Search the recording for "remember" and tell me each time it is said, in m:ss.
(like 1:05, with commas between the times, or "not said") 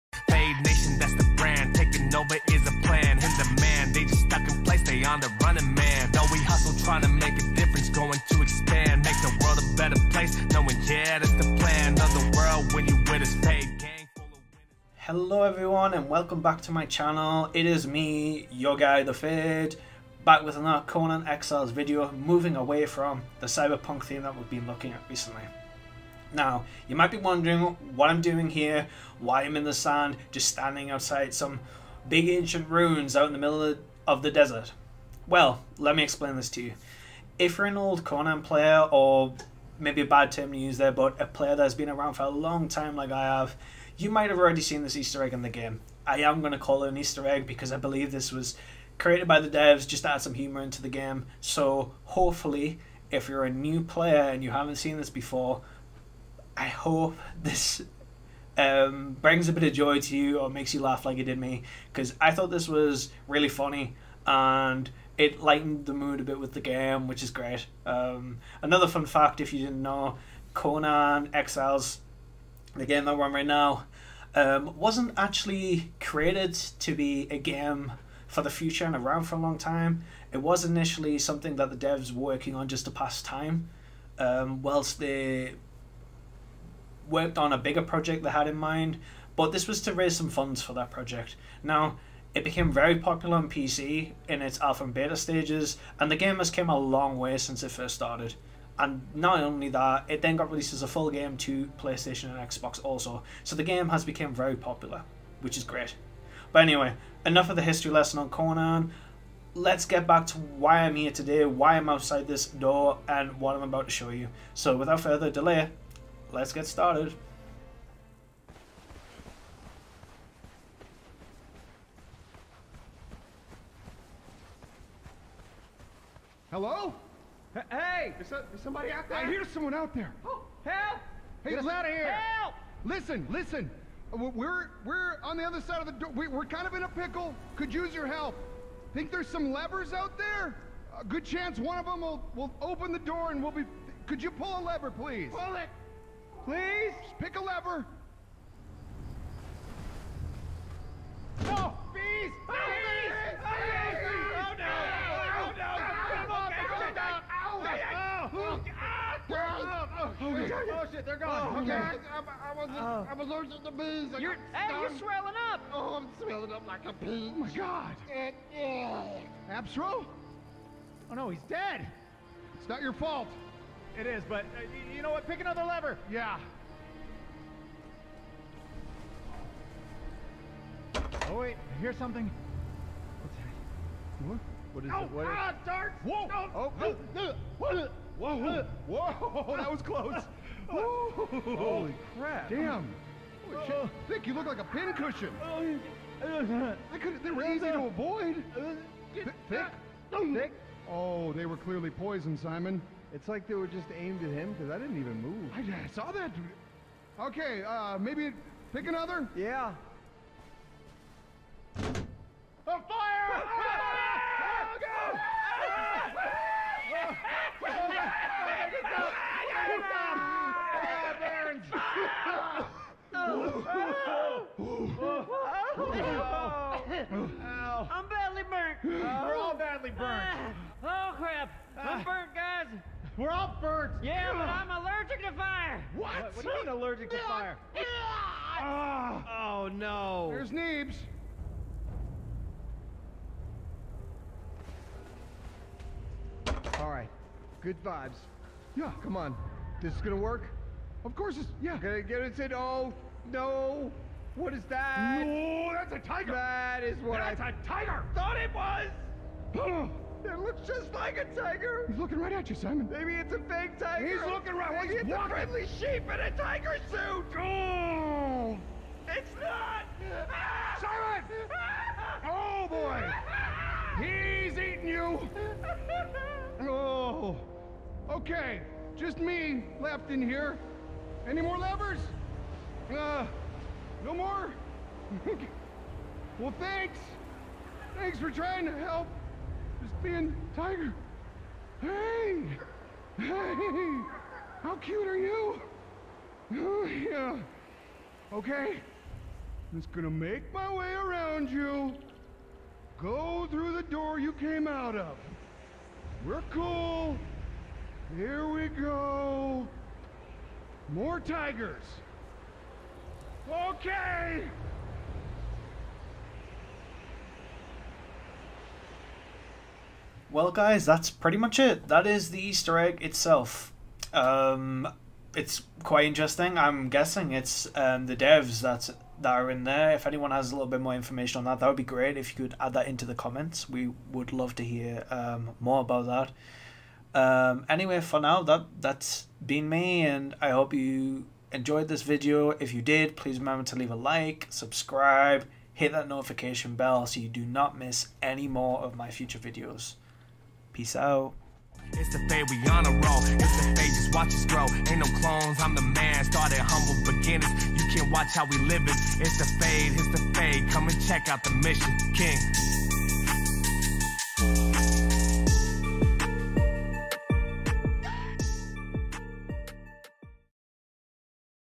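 5:43.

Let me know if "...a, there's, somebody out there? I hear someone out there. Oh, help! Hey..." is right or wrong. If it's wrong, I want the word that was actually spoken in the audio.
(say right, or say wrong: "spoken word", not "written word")
right.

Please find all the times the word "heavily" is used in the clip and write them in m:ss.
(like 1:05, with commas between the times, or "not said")
not said.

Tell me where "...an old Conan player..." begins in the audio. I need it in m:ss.
0:37.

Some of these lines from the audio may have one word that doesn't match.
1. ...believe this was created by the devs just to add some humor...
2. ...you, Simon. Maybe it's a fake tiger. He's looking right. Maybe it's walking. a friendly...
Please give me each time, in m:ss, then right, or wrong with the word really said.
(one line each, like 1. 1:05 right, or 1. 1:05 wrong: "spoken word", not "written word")
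1. 0:47 right
2. 4:22 right.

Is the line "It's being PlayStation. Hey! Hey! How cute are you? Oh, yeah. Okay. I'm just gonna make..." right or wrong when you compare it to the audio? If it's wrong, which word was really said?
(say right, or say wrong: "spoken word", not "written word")
wrong: "Tiger", not "PlayStation".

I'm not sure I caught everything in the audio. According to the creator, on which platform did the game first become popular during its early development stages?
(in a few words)
PC.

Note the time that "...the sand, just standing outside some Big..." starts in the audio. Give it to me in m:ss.
0:29.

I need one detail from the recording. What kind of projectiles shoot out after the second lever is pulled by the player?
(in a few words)
darts.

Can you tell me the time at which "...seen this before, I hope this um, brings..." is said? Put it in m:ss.
0:54.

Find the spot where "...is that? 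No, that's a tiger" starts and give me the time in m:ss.
4:14.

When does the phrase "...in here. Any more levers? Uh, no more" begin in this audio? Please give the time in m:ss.
4:40.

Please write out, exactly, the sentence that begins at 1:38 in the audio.
And not only that, it then got released as a full game to PlayStation and Xbox also.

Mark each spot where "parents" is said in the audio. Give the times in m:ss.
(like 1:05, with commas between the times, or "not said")
not said.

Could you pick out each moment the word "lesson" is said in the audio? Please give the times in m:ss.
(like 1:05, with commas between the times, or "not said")
1:47.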